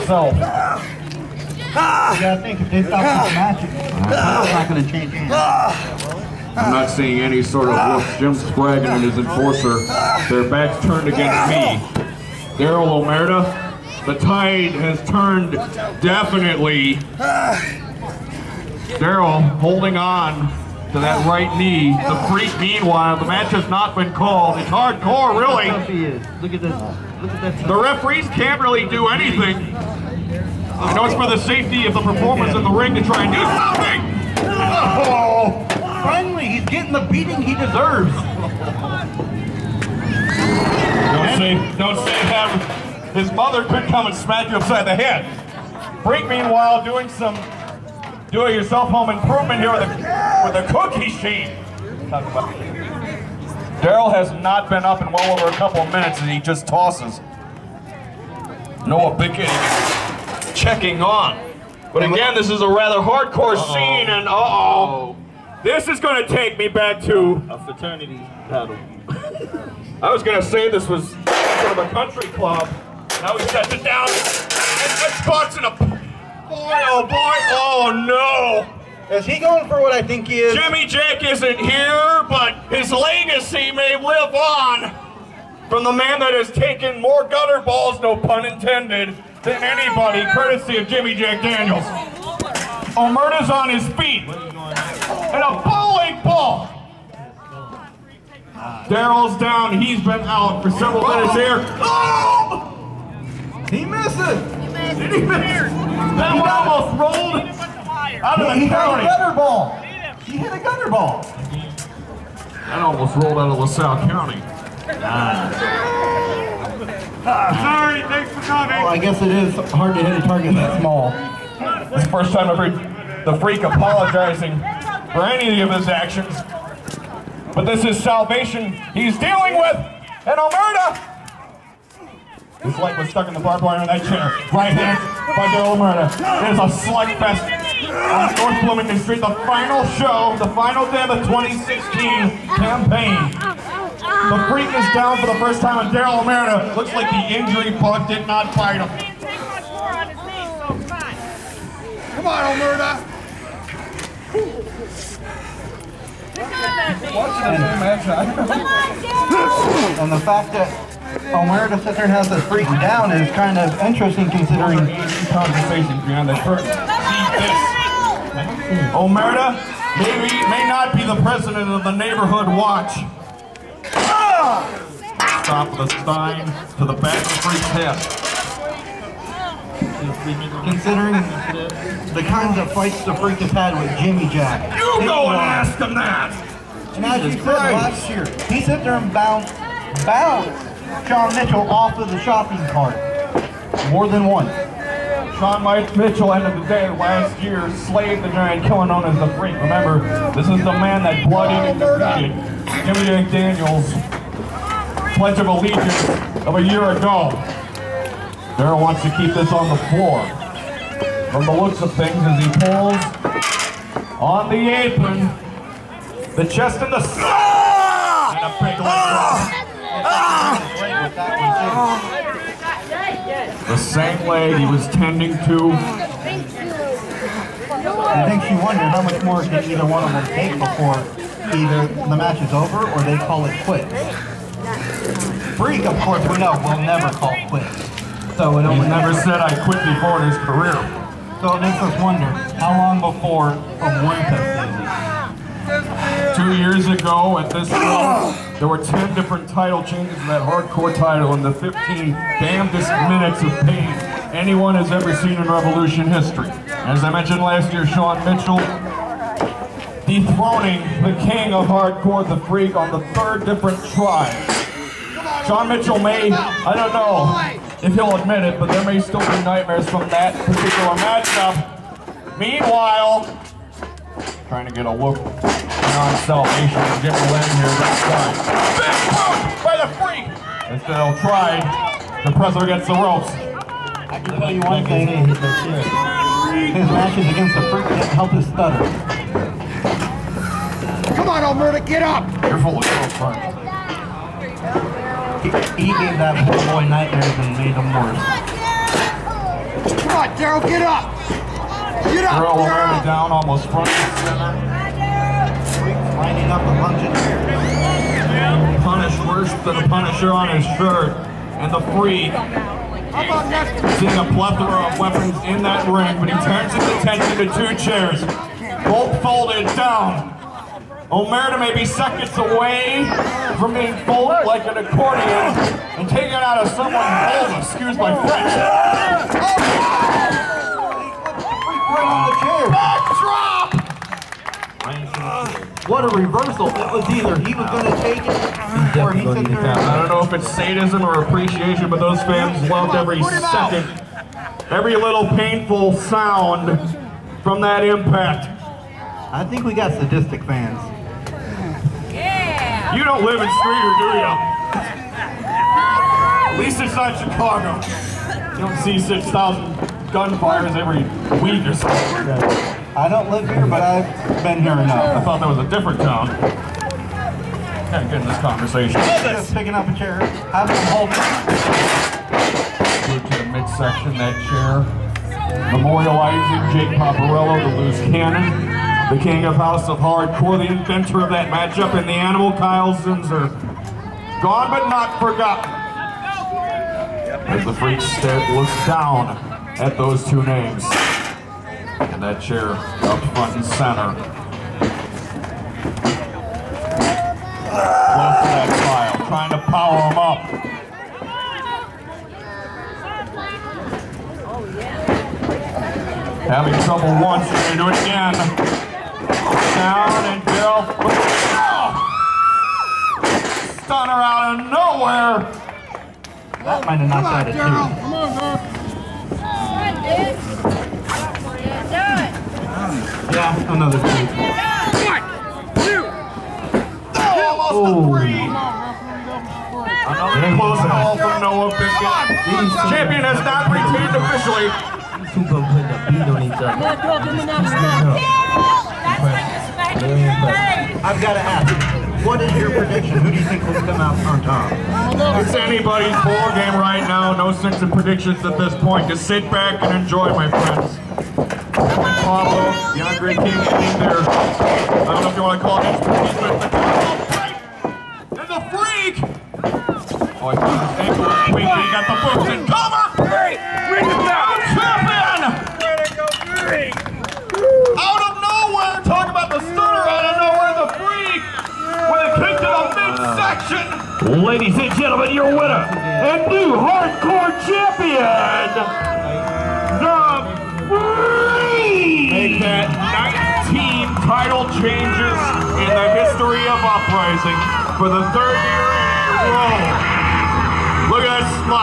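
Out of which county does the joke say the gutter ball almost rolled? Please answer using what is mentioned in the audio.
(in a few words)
LaSalle County.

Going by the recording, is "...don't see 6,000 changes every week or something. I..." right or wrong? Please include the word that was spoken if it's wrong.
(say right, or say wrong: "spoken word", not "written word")
wrong: "gunfires", not "changes".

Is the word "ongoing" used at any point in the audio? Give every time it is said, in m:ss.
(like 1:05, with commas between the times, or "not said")
not said.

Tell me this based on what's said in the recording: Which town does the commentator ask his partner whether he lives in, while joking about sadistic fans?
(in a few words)
Streator.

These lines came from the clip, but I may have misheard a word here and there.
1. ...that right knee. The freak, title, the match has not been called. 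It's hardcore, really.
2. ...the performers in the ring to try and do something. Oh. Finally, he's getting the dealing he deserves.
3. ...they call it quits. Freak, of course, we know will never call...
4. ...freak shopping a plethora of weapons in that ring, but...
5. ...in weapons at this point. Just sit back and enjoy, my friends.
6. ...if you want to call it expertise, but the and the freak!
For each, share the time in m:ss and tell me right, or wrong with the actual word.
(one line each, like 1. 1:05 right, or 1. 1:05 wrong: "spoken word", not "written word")
1. 0:20 wrong: "meanwhile", not "title"
2. 0:31 wrong: "beating", not "dealing"
3. 3:53 right
4. 5:11 wrong: "seeing", not "shopping"
5. 7:27 wrong: "predictions", not "weapons"
6. 7:35 right.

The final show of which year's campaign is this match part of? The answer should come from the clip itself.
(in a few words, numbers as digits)
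2016.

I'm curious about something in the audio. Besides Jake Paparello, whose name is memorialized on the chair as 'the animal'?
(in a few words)
Kyle Zinzer.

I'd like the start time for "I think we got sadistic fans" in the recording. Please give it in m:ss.
5:49.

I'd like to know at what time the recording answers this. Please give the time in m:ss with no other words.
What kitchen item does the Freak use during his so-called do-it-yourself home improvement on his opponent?
0:50.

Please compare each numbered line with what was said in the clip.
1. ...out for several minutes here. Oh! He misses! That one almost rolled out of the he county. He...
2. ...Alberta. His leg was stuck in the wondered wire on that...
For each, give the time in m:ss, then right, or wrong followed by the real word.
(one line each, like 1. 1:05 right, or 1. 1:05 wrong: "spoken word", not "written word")
1. 1:40 right
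2. 2:10 wrong: "barbed", not "wondered".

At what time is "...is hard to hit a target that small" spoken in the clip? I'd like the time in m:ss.
1:59.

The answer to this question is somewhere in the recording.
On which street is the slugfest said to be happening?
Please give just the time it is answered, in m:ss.
2:18.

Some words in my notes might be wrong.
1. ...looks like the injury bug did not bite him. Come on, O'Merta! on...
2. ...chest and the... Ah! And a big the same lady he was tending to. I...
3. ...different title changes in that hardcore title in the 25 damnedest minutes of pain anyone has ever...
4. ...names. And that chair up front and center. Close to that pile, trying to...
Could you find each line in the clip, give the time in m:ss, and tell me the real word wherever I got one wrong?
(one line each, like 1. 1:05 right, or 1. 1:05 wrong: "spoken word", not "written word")
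1. 2:26 right
2. 3:36 right
3. 4:09 wrong: "15", not "25"
4. 6:30 right.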